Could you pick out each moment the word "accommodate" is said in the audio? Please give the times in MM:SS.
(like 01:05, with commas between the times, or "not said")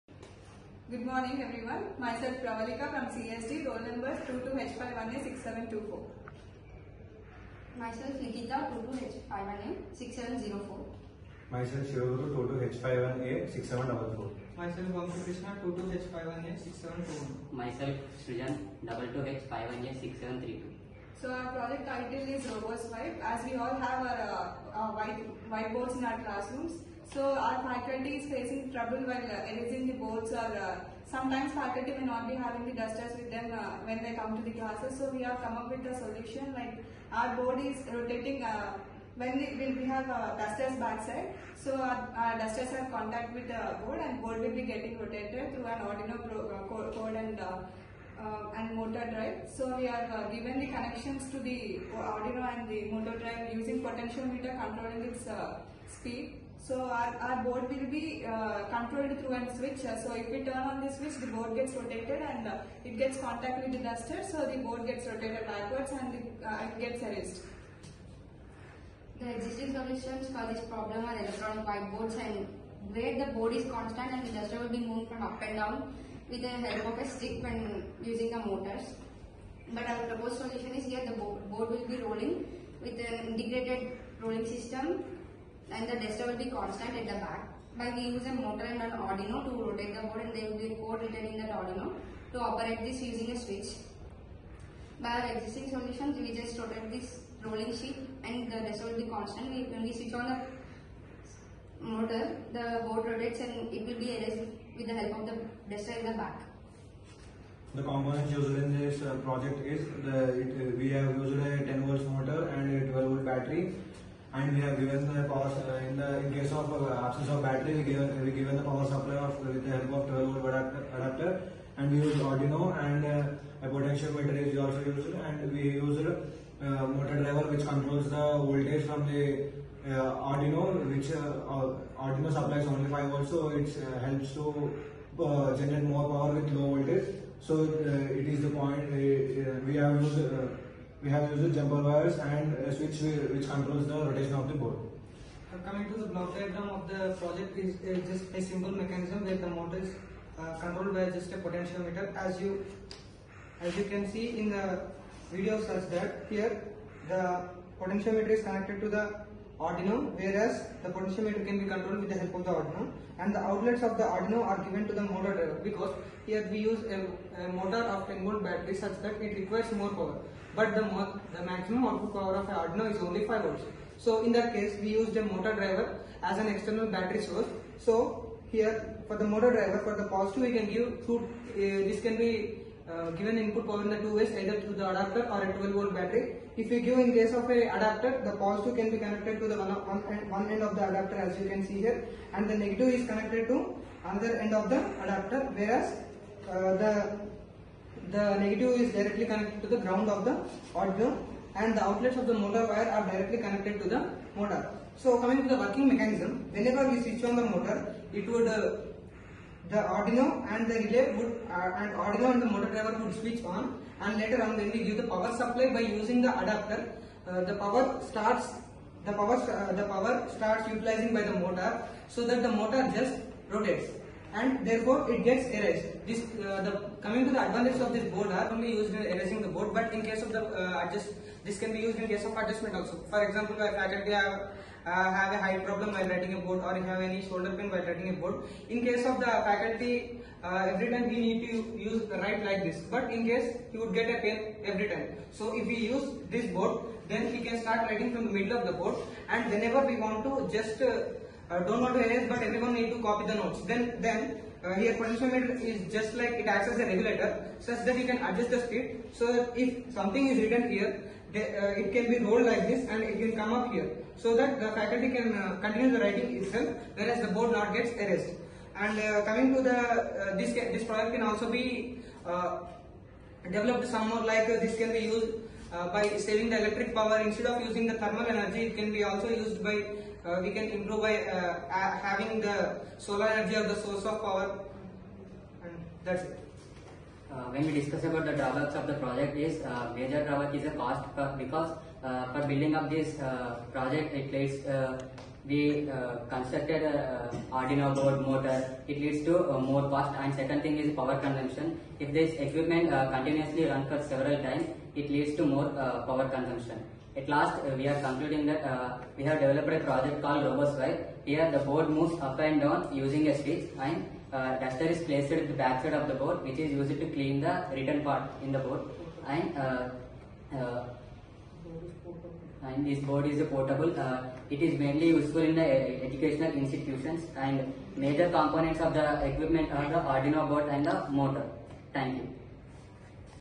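not said.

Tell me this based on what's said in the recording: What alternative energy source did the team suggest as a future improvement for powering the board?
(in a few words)
Solar energy.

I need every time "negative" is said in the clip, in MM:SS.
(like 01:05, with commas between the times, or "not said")
03:12, 03:18.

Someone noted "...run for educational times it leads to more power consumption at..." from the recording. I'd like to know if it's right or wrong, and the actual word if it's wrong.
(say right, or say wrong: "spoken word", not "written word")
wrong: "several", not "educational".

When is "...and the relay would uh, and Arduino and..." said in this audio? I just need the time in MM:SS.
03:30.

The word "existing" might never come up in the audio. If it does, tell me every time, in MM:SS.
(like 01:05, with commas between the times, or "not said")
01:09, 01:35.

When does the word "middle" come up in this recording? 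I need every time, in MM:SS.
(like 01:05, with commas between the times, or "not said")
04:08.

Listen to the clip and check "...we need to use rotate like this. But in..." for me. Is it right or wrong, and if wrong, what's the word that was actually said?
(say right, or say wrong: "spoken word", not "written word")
wrong: "write", not "rotate".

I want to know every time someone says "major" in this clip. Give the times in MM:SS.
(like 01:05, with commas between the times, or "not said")
04:49, 05:27.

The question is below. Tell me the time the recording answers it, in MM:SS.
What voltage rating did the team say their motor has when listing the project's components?
01:51.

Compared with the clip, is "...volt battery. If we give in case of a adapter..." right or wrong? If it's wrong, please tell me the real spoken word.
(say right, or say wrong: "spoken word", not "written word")
right.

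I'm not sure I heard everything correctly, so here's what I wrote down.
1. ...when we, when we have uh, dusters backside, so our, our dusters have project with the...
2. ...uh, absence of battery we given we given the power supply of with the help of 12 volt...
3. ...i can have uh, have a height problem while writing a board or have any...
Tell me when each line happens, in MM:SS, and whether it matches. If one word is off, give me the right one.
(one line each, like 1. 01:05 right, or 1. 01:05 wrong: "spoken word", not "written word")
1. 00:39 wrong: "contact", not "project"
2. 01:56 right
3. 03:53 right.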